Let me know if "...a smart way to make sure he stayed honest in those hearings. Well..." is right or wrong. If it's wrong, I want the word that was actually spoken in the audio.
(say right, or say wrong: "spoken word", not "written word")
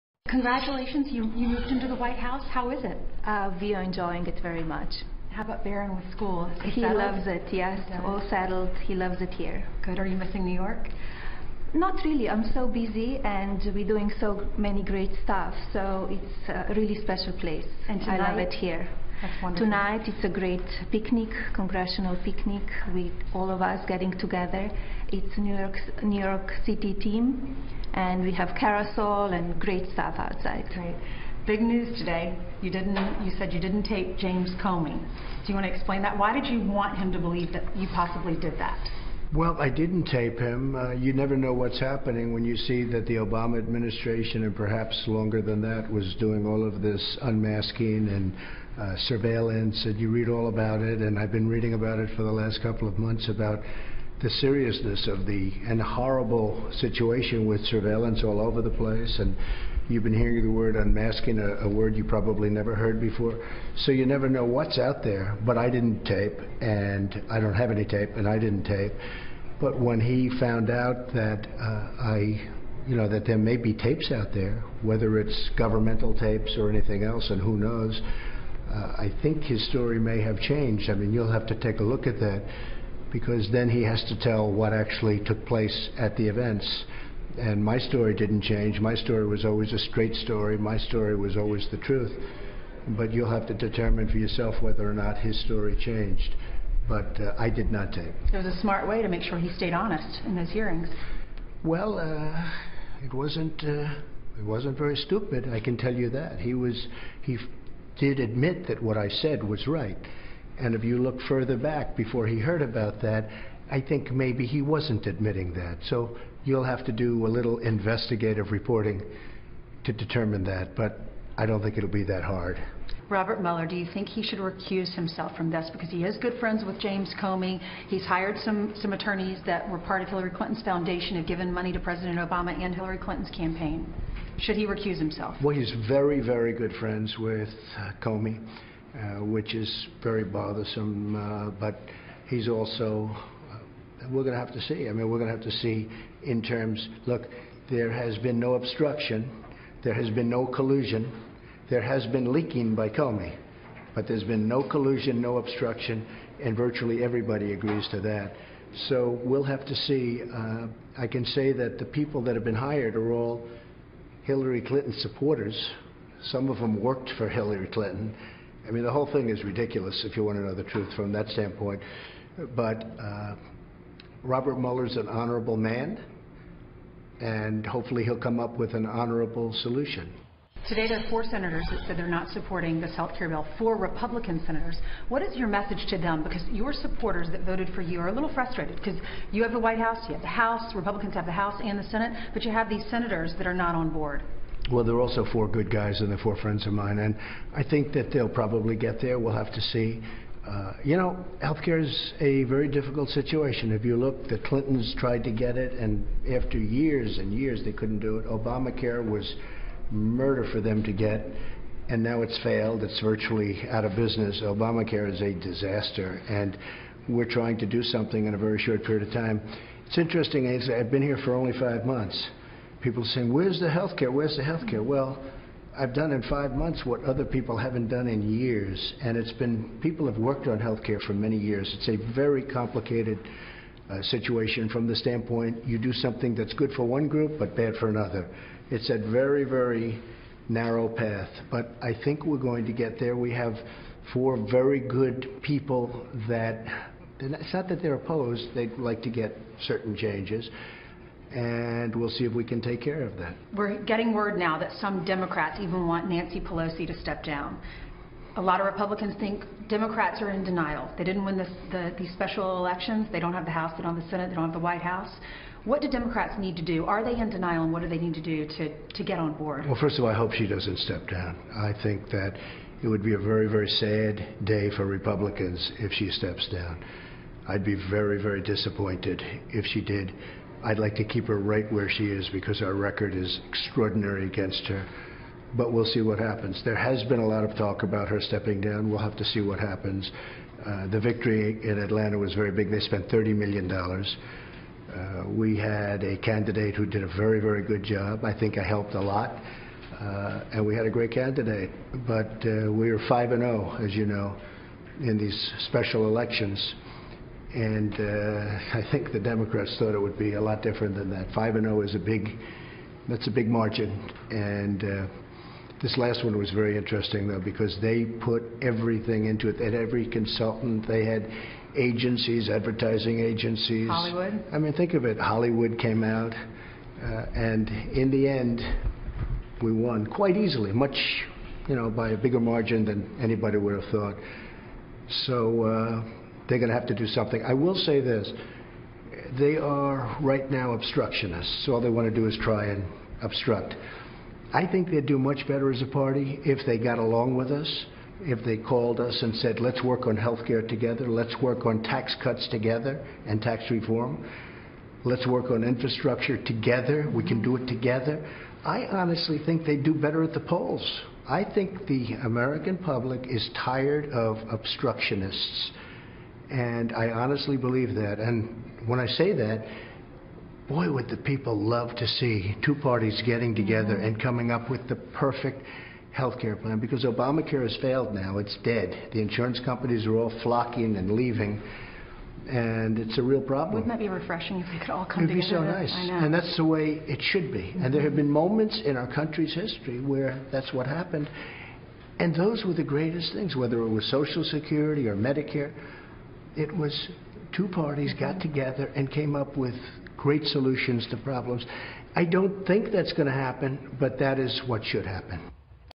right.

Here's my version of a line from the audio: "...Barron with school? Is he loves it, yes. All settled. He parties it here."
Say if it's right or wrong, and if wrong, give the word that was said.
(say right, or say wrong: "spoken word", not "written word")
wrong: "loves", not "parties".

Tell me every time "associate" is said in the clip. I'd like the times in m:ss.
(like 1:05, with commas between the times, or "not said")
not said.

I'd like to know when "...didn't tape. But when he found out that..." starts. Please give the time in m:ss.
1:08.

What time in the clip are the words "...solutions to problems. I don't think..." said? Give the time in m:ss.
6:40.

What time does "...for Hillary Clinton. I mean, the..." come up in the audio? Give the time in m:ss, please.
2:47.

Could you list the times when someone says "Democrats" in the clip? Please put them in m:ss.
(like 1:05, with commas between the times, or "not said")
4:15, 4:19, 4:25, 5:09.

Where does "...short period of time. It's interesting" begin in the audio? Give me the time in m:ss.
3:38.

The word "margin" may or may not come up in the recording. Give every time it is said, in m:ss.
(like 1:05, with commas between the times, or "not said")
5:13, 5:32.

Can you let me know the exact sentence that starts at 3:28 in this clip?
Obamacare was murder for them to get, and now it's failed.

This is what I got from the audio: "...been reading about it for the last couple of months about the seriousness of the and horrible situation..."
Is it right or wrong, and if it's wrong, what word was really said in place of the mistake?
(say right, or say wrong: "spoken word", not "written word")
right.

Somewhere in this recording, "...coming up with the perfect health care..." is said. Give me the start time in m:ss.
6:14.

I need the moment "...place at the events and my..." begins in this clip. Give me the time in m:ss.
1:25.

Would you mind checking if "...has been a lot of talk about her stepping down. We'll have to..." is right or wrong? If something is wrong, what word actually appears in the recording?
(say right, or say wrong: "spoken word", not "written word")
right.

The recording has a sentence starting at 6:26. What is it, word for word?
And that's the way it should be.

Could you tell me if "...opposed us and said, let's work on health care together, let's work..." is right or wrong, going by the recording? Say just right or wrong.
wrong.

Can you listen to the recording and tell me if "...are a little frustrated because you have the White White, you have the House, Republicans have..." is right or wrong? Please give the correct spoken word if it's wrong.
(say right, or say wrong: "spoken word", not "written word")
wrong: "House", not "White".